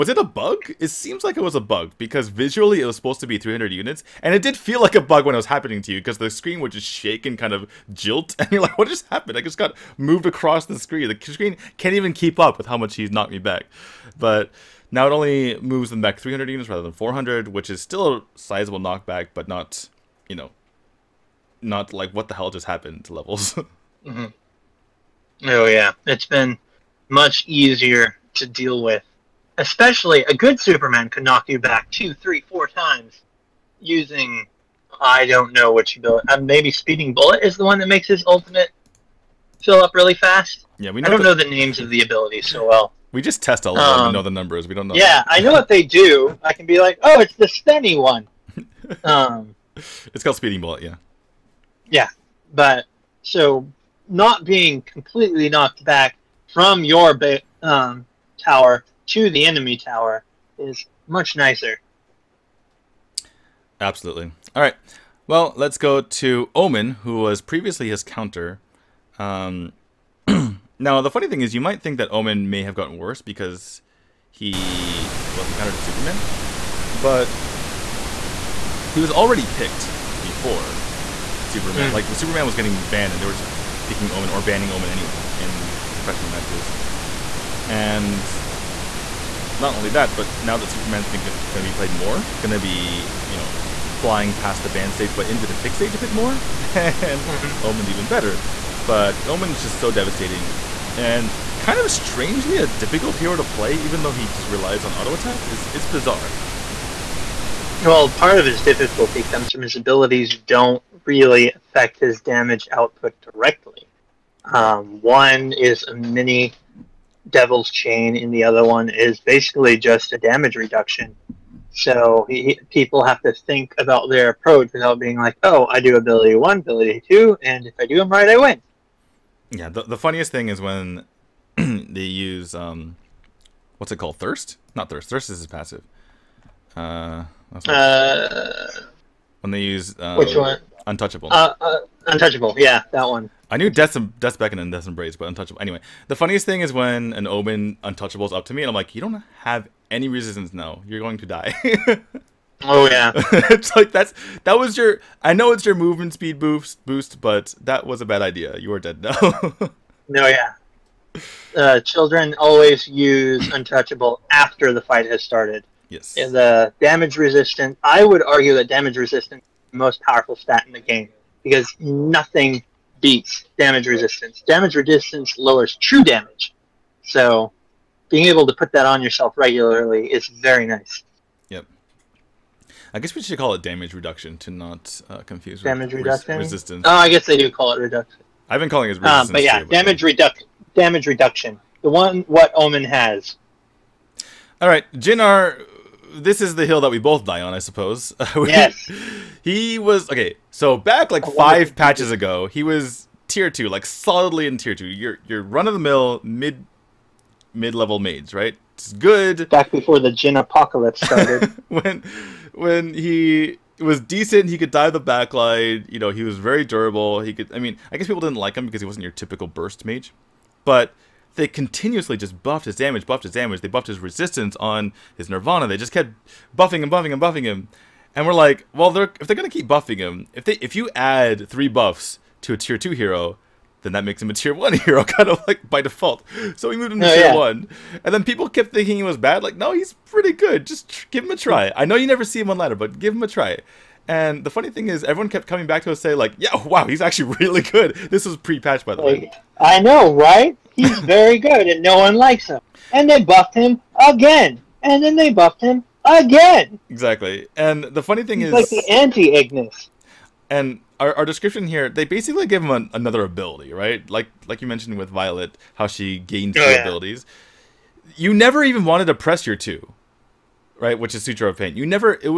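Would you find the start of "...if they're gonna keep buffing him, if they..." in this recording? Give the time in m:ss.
3:49.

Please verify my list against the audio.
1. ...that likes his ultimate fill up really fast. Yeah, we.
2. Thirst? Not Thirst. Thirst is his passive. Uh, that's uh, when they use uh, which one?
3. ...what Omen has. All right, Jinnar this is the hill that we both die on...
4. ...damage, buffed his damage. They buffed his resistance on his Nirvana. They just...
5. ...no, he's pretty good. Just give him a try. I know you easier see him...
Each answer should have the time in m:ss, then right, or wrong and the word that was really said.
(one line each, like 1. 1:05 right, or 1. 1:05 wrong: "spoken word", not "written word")
1. 0:37 wrong: "makes", not "likes"
2. 2:14 right
3. 3:12 right
4. 3:42 right
5. 3:59 wrong: "never", not "easier".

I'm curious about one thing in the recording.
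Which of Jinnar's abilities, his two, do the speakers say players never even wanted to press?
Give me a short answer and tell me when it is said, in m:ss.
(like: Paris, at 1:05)
Sutra of Pain, at 4:31.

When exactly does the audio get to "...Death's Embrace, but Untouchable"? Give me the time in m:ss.
2:24.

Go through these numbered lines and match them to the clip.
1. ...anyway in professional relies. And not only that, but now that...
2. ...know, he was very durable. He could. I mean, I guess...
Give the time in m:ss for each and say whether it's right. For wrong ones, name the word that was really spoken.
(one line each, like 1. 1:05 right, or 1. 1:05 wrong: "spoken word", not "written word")
1. 1:24 wrong: "matches", not "relies"
2. 3:35 right.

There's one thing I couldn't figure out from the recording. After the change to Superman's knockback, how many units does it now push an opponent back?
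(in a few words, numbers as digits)
300.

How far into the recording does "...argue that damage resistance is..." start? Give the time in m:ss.
2:48.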